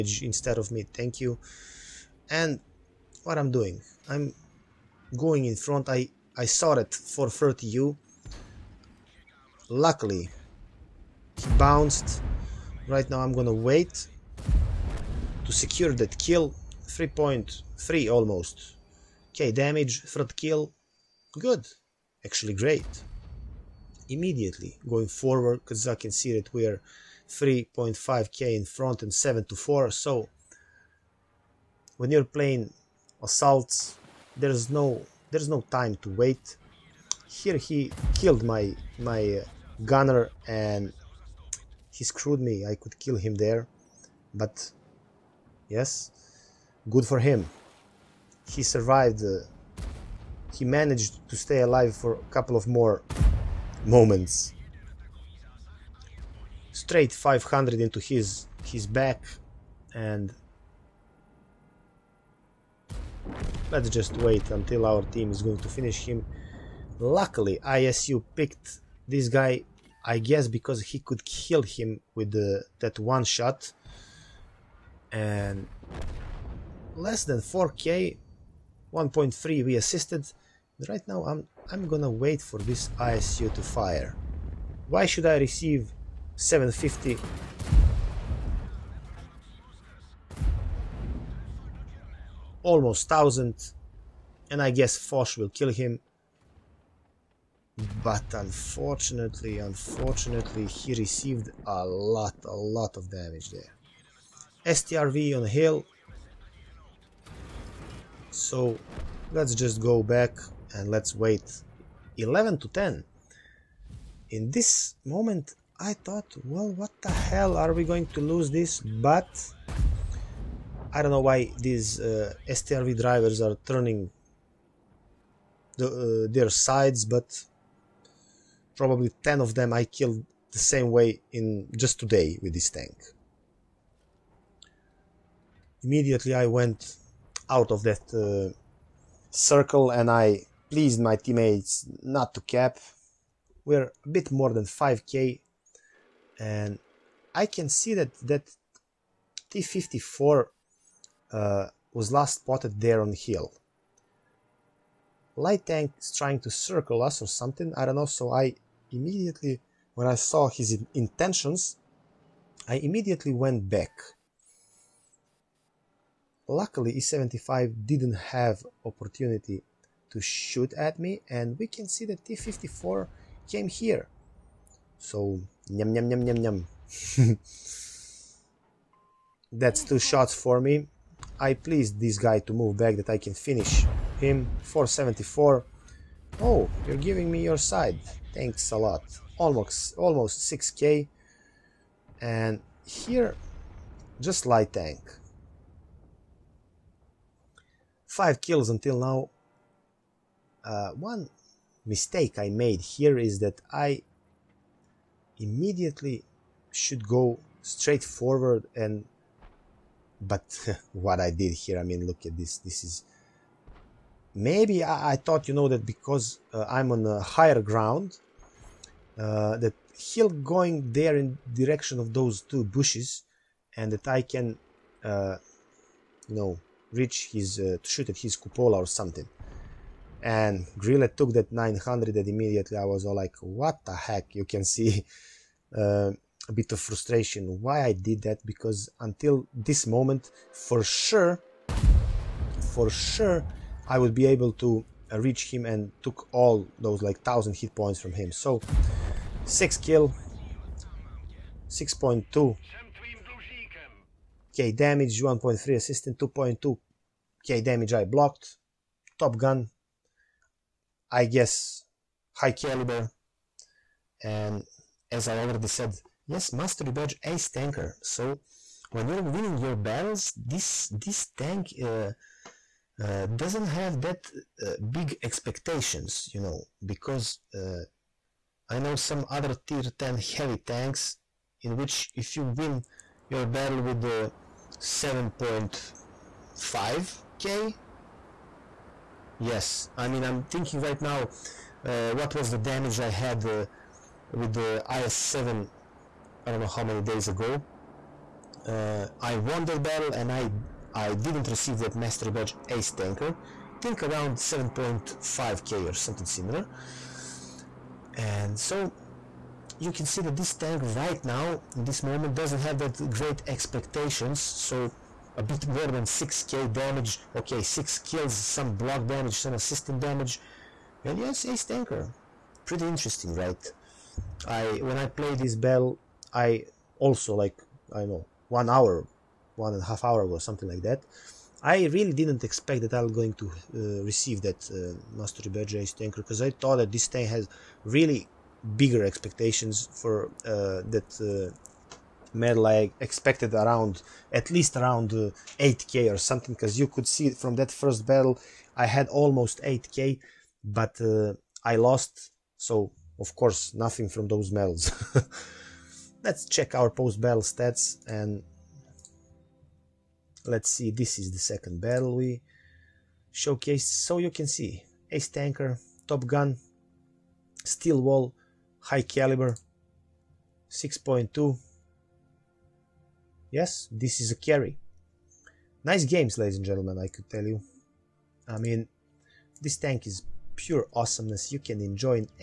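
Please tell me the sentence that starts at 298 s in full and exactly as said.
Uh, I won that battle and I I didn't receive that mastery badge ace tanker.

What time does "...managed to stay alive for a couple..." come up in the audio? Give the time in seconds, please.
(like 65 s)
50 s.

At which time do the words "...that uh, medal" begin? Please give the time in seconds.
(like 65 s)
340 s.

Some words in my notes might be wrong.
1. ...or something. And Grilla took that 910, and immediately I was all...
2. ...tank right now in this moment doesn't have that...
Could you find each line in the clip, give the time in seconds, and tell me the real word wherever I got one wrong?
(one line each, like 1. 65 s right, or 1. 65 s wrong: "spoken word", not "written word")
1. 228 s wrong: "900", not "910"
2. 310 s right.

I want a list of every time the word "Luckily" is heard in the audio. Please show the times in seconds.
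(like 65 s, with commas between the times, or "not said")
9 s, 66 s, 166 s.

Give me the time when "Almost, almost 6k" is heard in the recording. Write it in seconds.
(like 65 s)
189 s.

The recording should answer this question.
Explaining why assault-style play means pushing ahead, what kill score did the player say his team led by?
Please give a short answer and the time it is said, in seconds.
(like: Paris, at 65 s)
7 to 4, at 29 s.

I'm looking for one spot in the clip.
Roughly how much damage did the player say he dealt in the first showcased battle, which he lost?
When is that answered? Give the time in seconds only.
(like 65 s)
349 s.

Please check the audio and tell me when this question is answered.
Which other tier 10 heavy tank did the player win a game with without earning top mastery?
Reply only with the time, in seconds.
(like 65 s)
295 s.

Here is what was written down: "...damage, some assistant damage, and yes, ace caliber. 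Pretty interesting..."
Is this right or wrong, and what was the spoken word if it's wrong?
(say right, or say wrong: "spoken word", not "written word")
wrong: "tanker", not "caliber".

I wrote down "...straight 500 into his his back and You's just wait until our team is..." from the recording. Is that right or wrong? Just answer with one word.
wrong.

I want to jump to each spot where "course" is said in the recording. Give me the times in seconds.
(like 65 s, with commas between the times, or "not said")
353 s.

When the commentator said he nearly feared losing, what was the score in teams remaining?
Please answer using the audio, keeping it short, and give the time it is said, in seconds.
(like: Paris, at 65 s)
11 to 10, at 112 s.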